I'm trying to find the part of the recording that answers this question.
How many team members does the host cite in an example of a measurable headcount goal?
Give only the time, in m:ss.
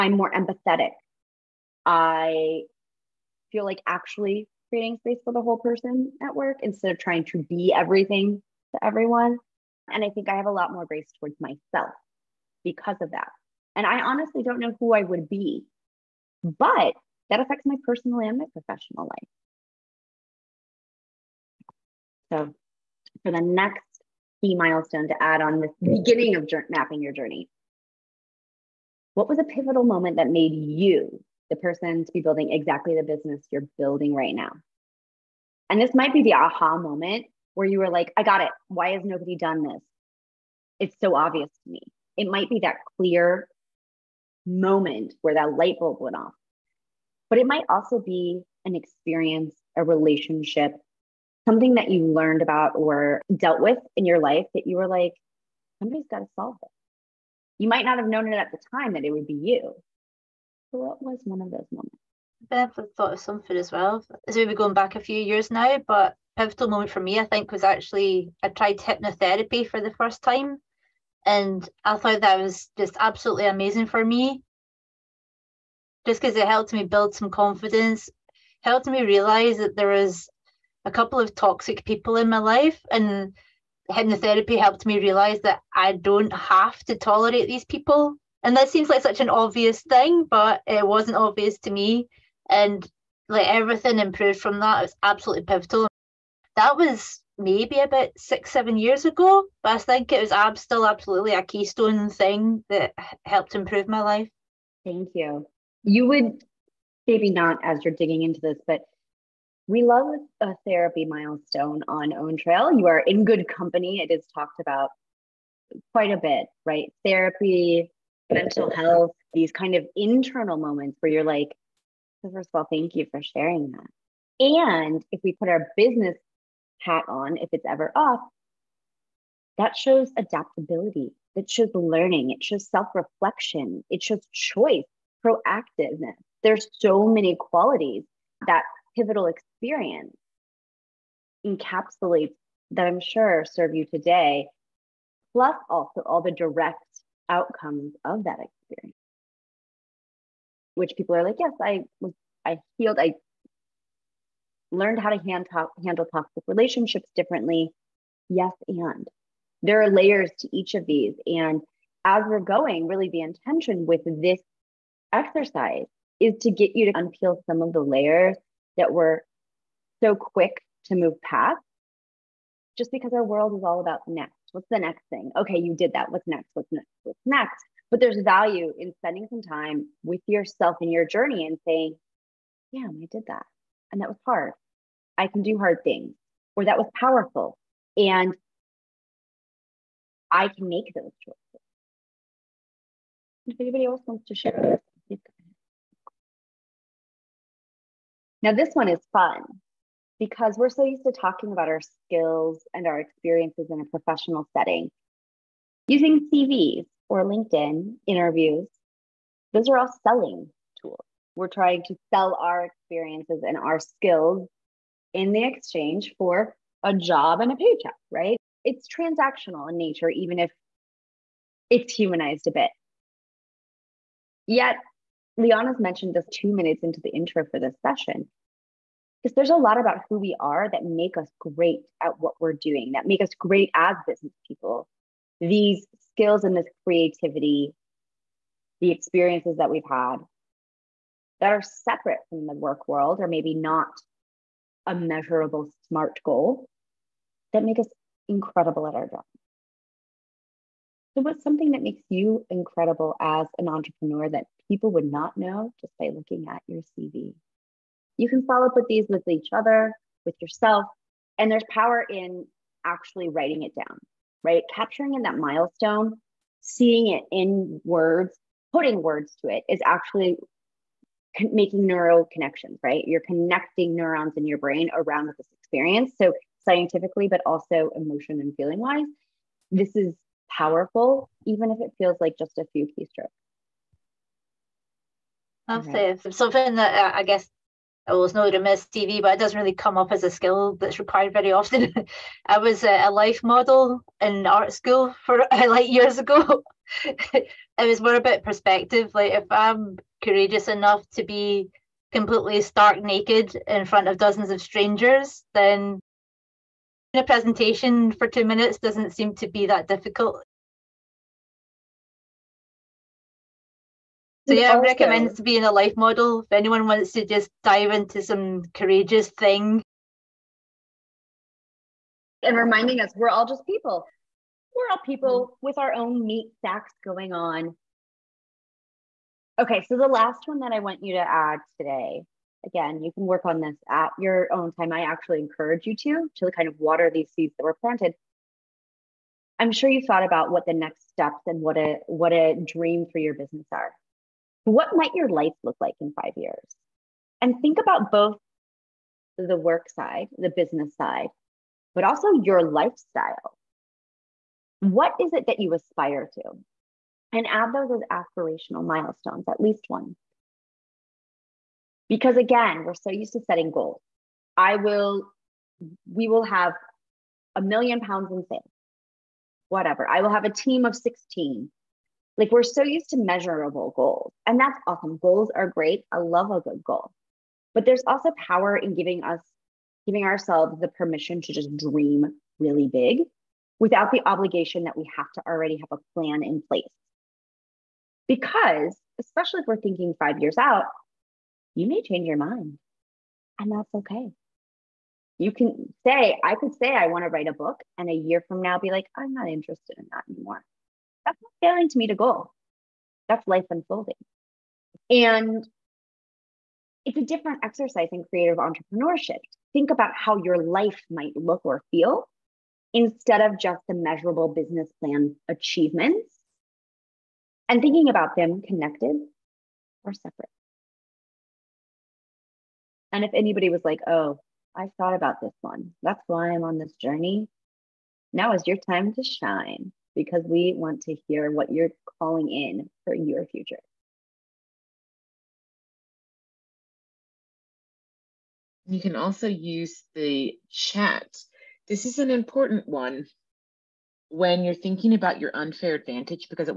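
6:10.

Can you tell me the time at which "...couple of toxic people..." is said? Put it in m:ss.
1:20.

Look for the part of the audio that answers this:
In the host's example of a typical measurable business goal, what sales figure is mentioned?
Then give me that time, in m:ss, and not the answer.
6:07.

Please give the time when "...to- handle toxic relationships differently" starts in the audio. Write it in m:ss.
2:35.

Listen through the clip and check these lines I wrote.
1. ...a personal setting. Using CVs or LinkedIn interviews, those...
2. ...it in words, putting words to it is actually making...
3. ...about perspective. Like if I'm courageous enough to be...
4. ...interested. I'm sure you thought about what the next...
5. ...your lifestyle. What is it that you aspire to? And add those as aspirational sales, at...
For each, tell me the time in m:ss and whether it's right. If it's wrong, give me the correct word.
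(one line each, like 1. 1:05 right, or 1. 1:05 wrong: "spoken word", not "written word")
1. 3:23 wrong: "professional", not "personal"
2. 4:27 right
3. 4:58 right
4. 5:37 wrong: "planted", not "interested"
5. 5:52 wrong: "milestones", not "sales".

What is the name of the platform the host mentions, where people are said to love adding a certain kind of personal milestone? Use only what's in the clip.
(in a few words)
Own Trail.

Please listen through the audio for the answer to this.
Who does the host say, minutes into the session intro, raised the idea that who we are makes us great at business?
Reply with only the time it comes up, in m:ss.
3:45.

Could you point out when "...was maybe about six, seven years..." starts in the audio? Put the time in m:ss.
1:36.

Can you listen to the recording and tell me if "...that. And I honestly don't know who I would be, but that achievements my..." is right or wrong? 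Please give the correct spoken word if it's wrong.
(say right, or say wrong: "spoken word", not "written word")
wrong: "affects", not "achievements".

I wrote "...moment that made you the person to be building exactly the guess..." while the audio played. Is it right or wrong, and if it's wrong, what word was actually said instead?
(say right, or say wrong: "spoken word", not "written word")
wrong: "business", not "guess".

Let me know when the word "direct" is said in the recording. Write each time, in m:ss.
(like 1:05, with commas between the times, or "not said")
2:26.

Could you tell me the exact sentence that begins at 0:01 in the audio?
I feel like actually creating space for the whole person at work instead of trying to be everything to everyone.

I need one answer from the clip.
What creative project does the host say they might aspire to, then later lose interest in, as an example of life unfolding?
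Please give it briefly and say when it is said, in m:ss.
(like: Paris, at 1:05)
Write a book, at 6:37.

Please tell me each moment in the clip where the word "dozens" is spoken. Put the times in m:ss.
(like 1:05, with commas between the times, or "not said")
5:04.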